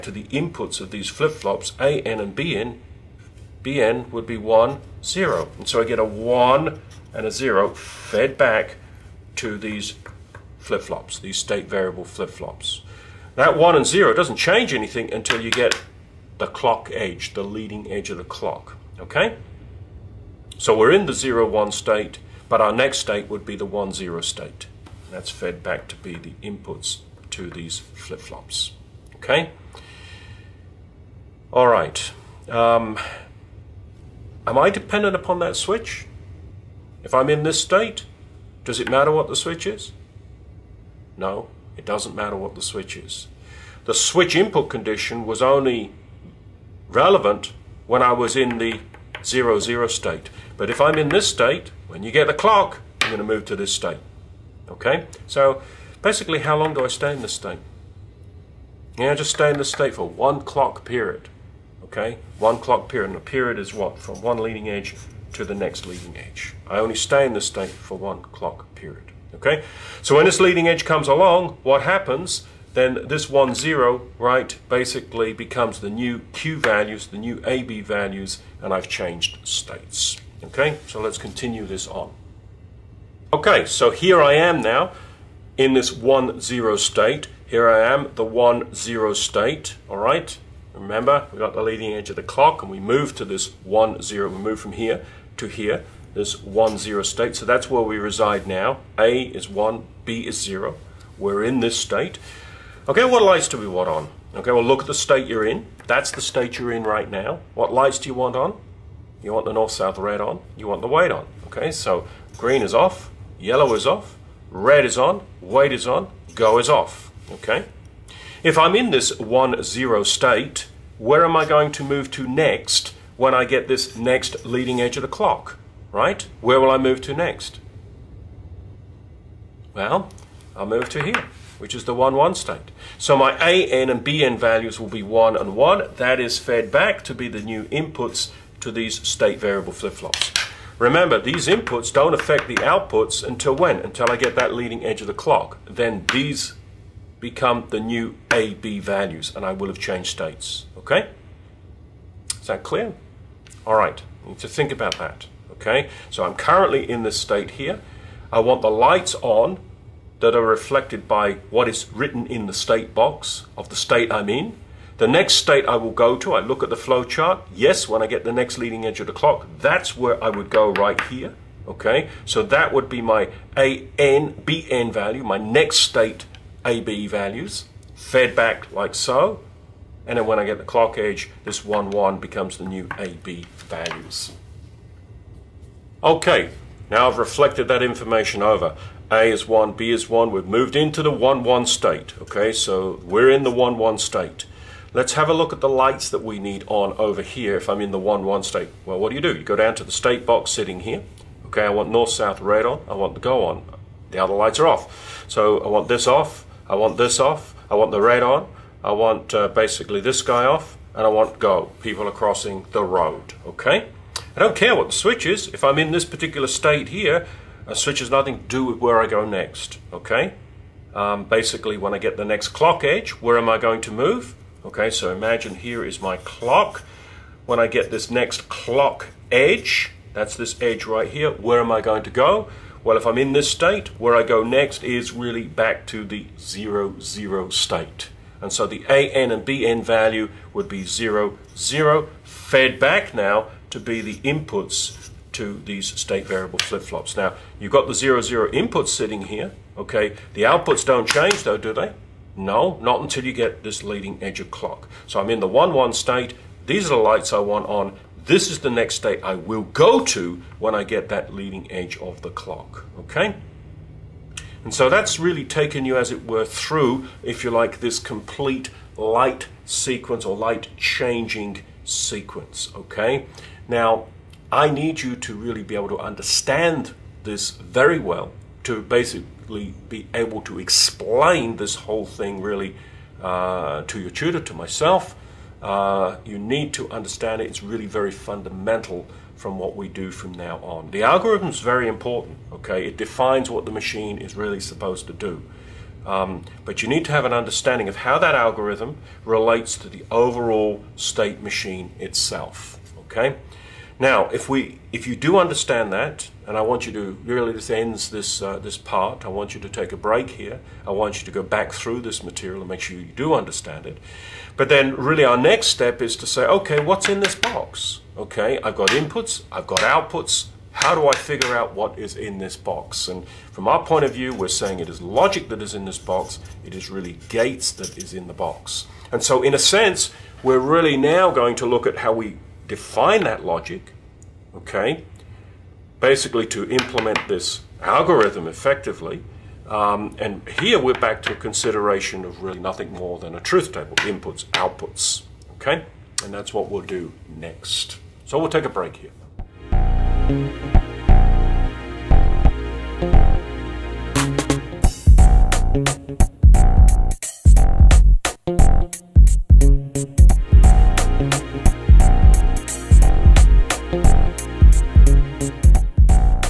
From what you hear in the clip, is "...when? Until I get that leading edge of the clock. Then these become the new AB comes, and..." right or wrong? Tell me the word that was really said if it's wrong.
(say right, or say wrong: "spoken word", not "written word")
wrong: "values", not "comes".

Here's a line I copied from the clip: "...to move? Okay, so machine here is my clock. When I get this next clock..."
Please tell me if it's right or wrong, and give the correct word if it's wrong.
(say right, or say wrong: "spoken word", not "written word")
wrong: "imagine", not "machine".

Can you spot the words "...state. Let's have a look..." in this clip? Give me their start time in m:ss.
3:13.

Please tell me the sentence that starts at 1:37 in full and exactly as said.
So that's where we reside now.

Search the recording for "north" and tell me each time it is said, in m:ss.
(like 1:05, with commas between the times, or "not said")
1:49, 3:21.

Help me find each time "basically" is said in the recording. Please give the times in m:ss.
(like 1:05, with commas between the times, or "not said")
0:56, 1:14, 3:29, 3:41, 4:38, 5:35.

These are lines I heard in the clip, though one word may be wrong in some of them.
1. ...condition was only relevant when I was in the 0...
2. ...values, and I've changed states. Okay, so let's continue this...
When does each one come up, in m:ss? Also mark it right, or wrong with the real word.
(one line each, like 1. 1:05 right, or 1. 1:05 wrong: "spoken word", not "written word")
1. 0:44 right
2. 1:17 right.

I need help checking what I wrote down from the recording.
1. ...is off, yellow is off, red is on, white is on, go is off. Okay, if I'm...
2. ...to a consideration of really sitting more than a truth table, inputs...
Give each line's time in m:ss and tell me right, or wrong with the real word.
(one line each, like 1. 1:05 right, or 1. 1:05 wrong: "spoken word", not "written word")
1. 1:52 right
2. 5:41 wrong: "nothing", not "sitting".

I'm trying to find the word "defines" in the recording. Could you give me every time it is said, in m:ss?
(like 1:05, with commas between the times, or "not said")
4:52, 5:32.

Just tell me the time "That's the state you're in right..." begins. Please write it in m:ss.
1:45.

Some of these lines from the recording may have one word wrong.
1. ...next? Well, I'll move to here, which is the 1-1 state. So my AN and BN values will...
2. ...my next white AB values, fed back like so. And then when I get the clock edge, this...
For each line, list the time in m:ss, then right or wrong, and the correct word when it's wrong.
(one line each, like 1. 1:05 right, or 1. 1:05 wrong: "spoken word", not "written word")
1. 2:07 right
2. 2:55 wrong: "state", not "white".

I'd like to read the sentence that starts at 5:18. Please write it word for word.
Okay, I've got inputs, I've got outputs.